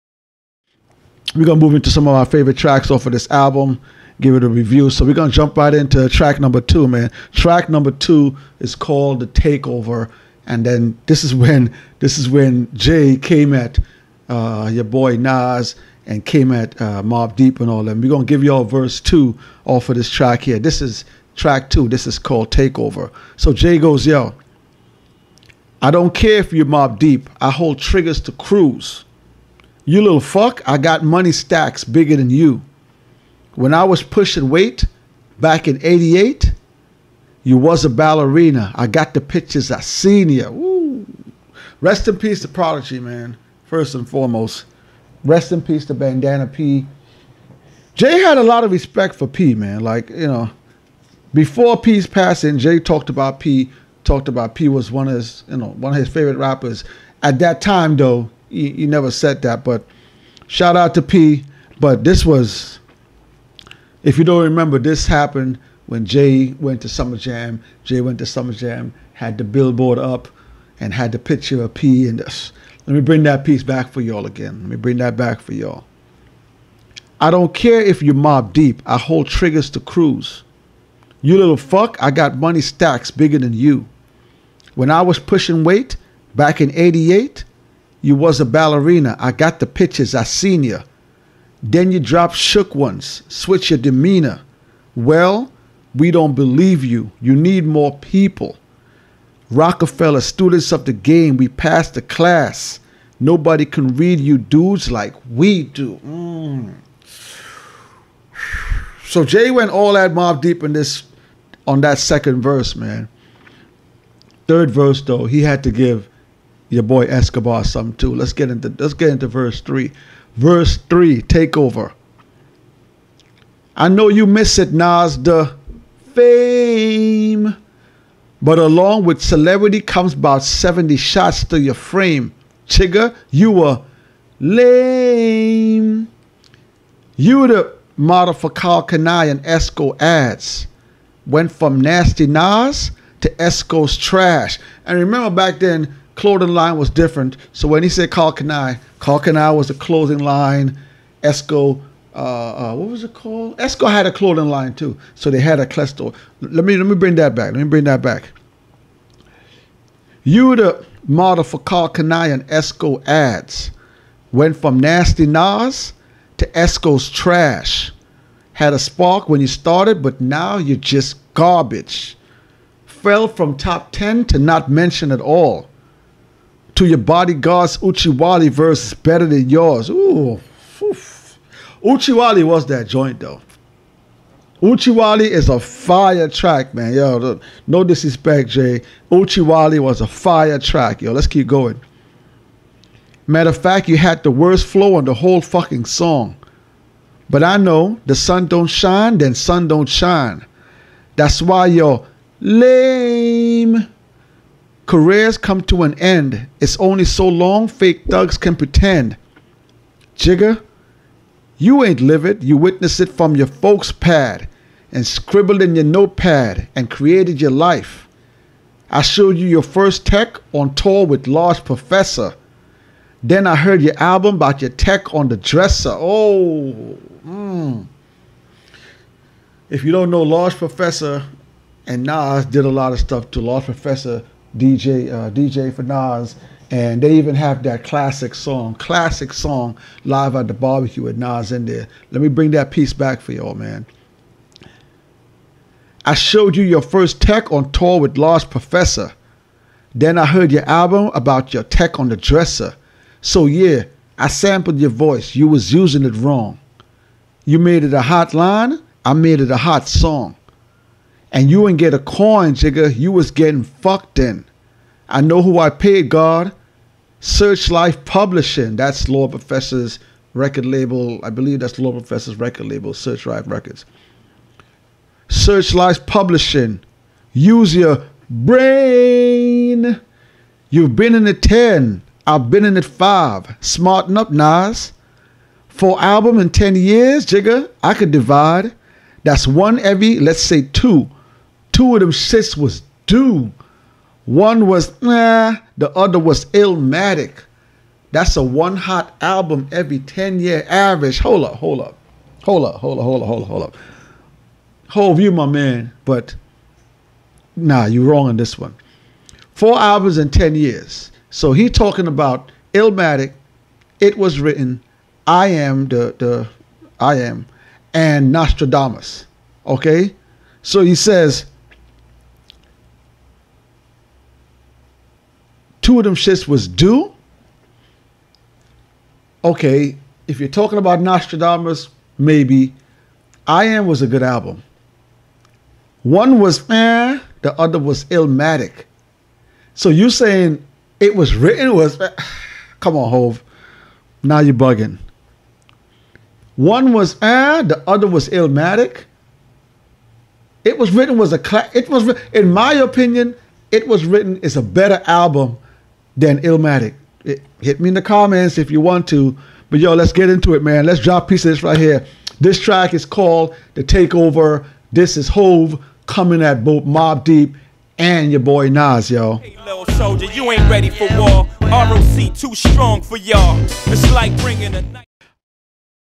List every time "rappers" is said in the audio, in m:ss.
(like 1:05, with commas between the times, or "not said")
0:56.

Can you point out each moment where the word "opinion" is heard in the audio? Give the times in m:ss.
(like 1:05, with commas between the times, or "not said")
5:52.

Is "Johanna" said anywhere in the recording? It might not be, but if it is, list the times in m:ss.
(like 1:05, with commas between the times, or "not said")
not said.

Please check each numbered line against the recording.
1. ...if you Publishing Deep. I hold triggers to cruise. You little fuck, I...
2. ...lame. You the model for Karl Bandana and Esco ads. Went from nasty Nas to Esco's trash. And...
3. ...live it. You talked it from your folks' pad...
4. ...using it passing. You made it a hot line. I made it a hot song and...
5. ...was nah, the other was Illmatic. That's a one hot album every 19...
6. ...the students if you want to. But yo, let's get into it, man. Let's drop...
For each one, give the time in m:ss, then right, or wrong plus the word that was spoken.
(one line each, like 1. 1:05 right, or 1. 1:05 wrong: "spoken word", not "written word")
1. 1:17 wrong: "Mobb", not "Publishing"
2. 2:14 wrong: "Kani", not "Bandana"
3. 3:32 wrong: "witnessed", not "talked"
4. 4:15 wrong: "wrong", not "passing"
5. 4:54 wrong: "10", not "19"
6. 5:57 wrong: "comments", not "students".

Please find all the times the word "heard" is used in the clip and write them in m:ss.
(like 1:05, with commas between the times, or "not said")
3:43, 4:10.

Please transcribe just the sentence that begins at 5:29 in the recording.
Okay, if you're talking about Nostradamus, maybe.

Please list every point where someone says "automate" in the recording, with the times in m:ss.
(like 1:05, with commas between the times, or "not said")
not said.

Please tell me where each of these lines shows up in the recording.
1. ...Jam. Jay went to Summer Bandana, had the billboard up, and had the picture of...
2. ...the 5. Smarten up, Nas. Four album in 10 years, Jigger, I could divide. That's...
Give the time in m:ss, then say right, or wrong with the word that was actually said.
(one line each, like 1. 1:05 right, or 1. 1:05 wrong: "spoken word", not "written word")
1. 1:07 wrong: "Jam", not "Bandana"
2. 4:42 right.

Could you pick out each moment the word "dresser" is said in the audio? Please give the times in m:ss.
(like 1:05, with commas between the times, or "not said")
3:45, 4:12.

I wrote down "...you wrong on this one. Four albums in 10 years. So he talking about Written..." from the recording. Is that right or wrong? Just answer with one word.
wrong.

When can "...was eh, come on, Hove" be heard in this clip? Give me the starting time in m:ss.
5:41.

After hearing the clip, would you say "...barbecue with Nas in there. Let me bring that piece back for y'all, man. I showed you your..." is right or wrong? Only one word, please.
right.